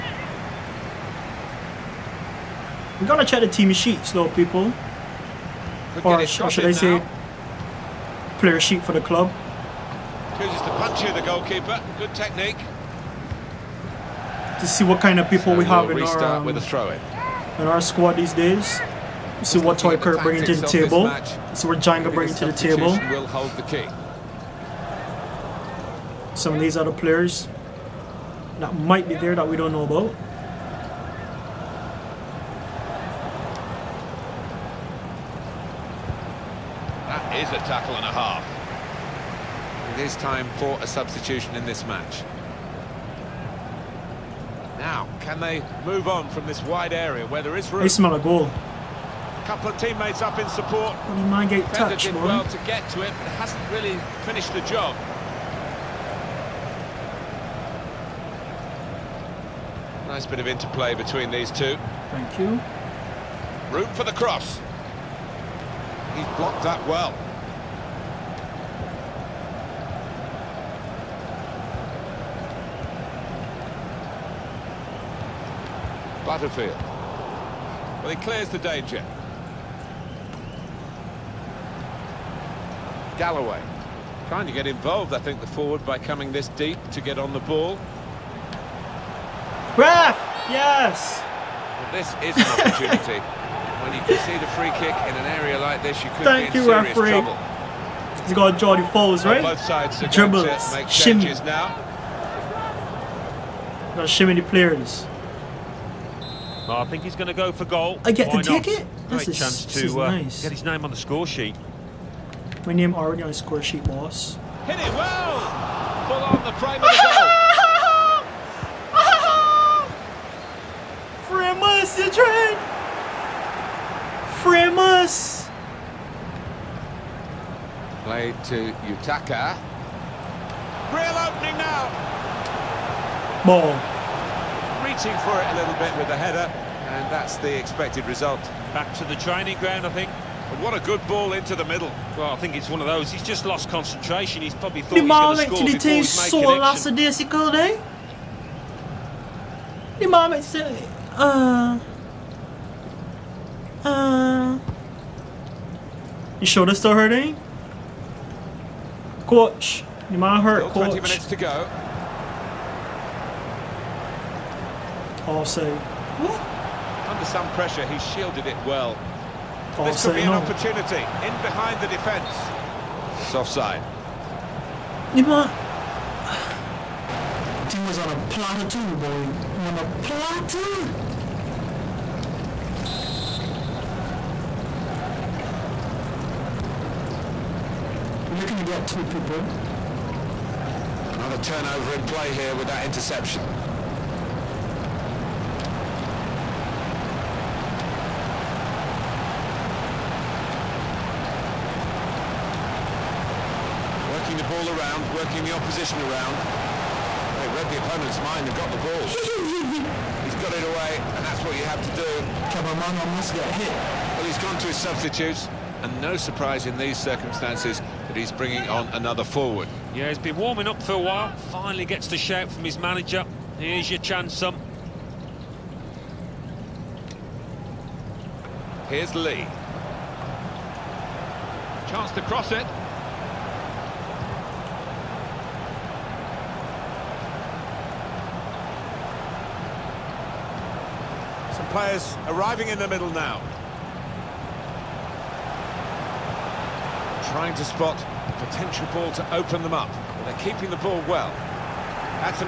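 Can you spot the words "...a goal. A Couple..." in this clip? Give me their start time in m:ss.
0:48.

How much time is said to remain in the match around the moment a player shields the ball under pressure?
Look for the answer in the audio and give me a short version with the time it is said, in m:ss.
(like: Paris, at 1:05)
20 minutes, at 2:40.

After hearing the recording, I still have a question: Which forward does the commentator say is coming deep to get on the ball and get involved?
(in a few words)
Galloway.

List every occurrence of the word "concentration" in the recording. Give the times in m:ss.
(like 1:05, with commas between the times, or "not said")
2:23.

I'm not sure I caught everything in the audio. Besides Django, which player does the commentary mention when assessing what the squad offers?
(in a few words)
Toy Kirk.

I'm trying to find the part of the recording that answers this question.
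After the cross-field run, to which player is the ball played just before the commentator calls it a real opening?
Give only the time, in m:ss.
2:08.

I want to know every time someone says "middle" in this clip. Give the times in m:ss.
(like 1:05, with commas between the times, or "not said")
2:21, 4:02.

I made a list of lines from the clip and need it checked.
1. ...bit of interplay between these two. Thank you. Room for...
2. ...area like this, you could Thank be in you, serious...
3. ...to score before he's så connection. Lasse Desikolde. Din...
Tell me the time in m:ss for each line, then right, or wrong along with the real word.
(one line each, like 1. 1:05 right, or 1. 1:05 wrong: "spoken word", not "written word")
1. 1:00 right
2. 1:35 right
3. 2:25 right.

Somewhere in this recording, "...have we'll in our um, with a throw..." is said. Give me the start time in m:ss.
0:15.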